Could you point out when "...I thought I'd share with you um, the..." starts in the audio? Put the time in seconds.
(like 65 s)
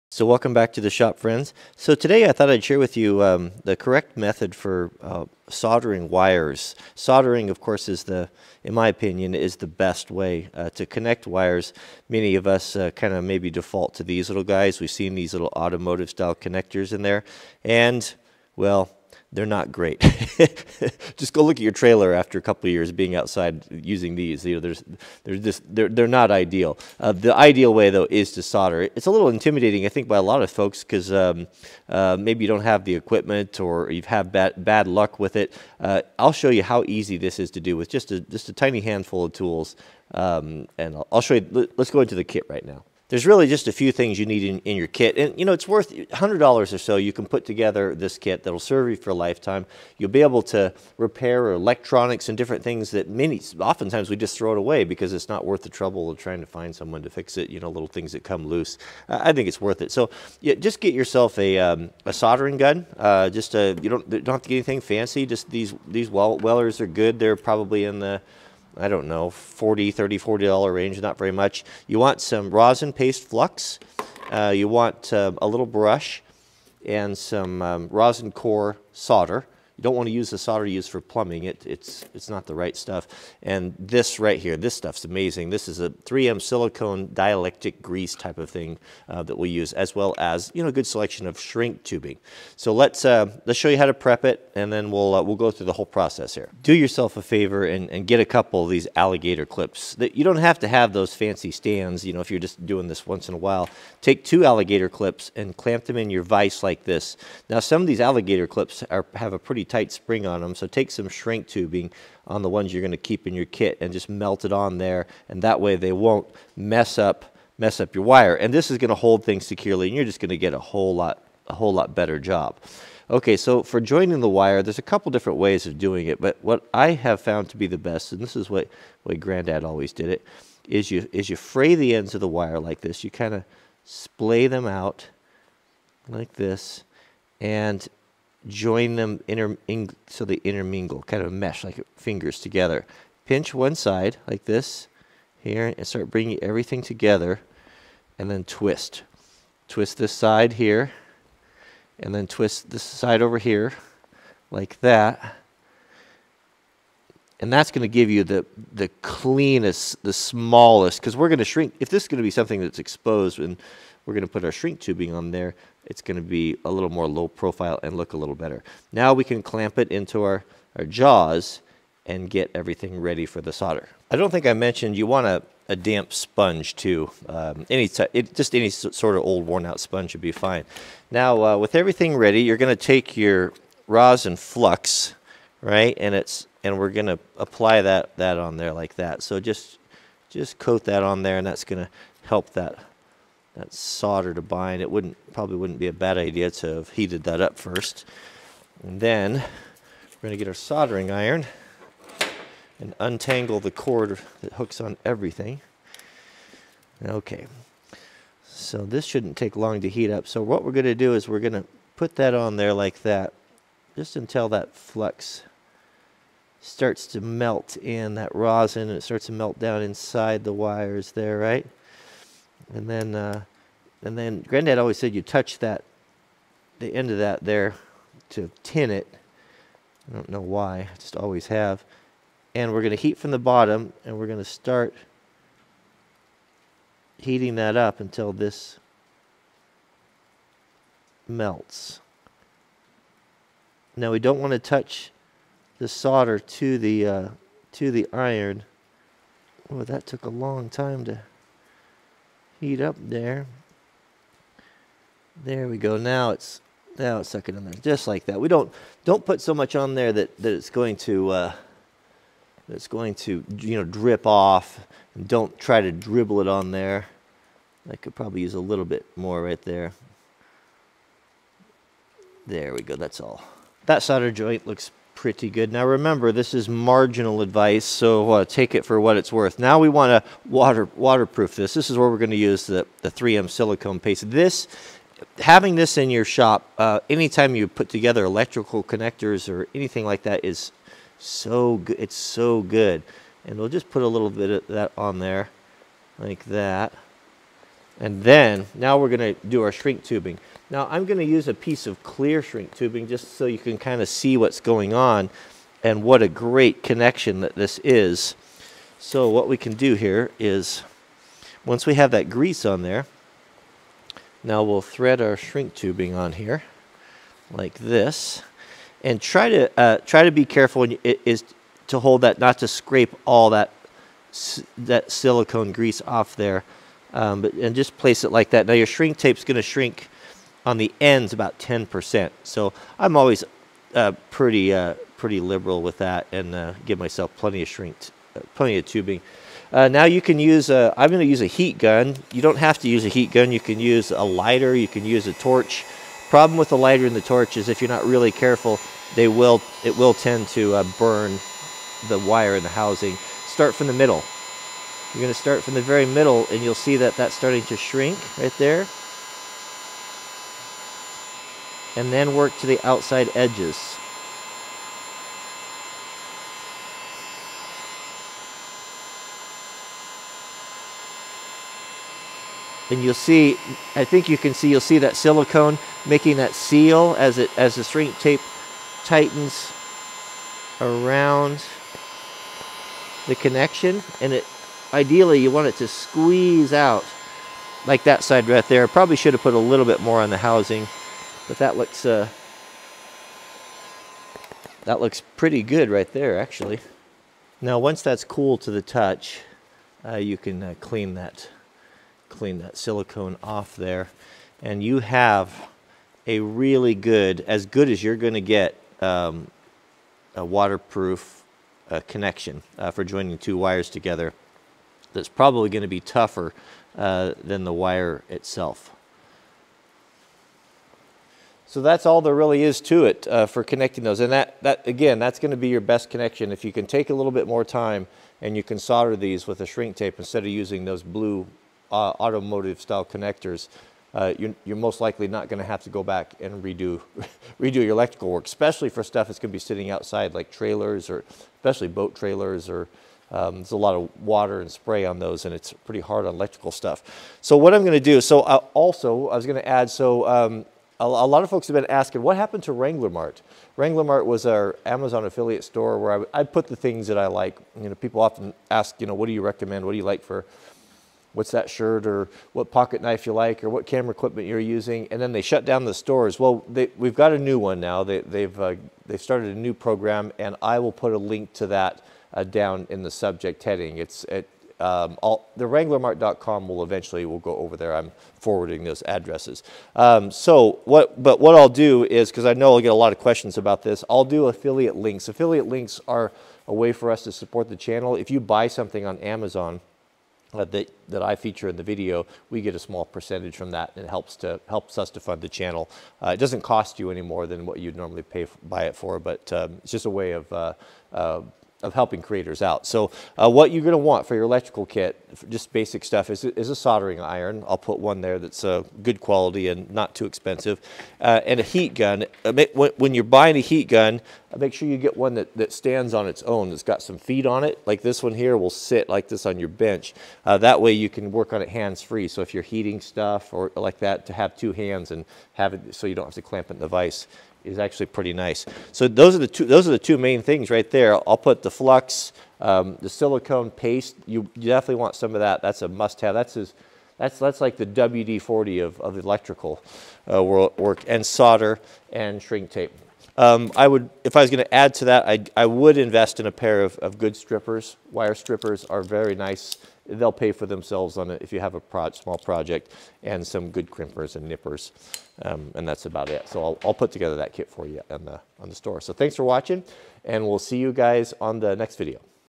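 2 s.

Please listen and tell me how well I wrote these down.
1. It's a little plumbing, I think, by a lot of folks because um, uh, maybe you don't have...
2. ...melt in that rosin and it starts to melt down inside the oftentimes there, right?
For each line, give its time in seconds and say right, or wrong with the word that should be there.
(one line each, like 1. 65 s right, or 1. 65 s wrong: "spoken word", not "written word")
1. 28 s wrong: "intimidating", not "plumbing"
2. 217 s wrong: "wires", not "oftentimes".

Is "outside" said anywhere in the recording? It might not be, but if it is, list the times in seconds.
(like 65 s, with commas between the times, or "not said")
23 s, 362 s, 439 s.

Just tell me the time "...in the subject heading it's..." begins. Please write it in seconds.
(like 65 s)
472 s.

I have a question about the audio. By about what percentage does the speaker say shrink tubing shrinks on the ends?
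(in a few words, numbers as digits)
10%.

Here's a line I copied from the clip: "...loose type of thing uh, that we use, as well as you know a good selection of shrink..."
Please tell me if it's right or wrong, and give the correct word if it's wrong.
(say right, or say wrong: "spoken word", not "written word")
wrong: "grease", not "loose".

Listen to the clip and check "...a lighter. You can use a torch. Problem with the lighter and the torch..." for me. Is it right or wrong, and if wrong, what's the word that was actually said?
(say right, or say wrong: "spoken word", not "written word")
right.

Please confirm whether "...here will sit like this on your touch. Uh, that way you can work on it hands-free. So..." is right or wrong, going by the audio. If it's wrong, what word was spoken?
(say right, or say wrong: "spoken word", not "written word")
wrong: "bench", not "touch".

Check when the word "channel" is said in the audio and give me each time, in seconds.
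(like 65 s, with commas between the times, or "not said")
487 s, 495 s.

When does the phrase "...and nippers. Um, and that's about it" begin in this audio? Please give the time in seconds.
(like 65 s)
554 s.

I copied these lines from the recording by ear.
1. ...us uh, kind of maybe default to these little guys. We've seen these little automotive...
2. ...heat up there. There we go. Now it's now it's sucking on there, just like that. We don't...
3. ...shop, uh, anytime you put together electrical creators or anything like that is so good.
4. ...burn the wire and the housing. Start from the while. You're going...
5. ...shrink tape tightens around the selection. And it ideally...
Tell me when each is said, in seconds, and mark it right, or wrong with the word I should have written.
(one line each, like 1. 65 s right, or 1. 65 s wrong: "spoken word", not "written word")
1. 12 s right
2. 252 s right
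3. 286 s wrong: "connectors", not "creators"
4. 350 s wrong: "middle", not "while"
5. 377 s wrong: "connection", not "selection".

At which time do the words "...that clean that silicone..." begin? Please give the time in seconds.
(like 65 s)
401 s.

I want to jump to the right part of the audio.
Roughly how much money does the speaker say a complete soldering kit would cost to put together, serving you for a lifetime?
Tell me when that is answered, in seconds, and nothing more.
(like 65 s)
45 s.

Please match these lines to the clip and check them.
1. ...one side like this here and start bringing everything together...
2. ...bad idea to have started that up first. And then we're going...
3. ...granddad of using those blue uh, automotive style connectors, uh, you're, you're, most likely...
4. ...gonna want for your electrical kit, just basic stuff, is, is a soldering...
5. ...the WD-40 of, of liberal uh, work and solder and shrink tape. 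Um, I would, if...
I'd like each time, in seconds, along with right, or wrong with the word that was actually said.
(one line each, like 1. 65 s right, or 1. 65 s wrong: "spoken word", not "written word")
1. 143 s right
2. 195 s wrong: "heated", not "started"
3. 430 s wrong: "instead", not "granddad"
4. 503 s right
5. 537 s wrong: "electrical", not "liberal".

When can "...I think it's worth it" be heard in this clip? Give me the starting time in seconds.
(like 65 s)
59 s.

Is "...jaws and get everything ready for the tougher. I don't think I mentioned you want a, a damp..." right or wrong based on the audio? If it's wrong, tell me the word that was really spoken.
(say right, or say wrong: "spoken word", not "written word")
wrong: "solder", not "tougher".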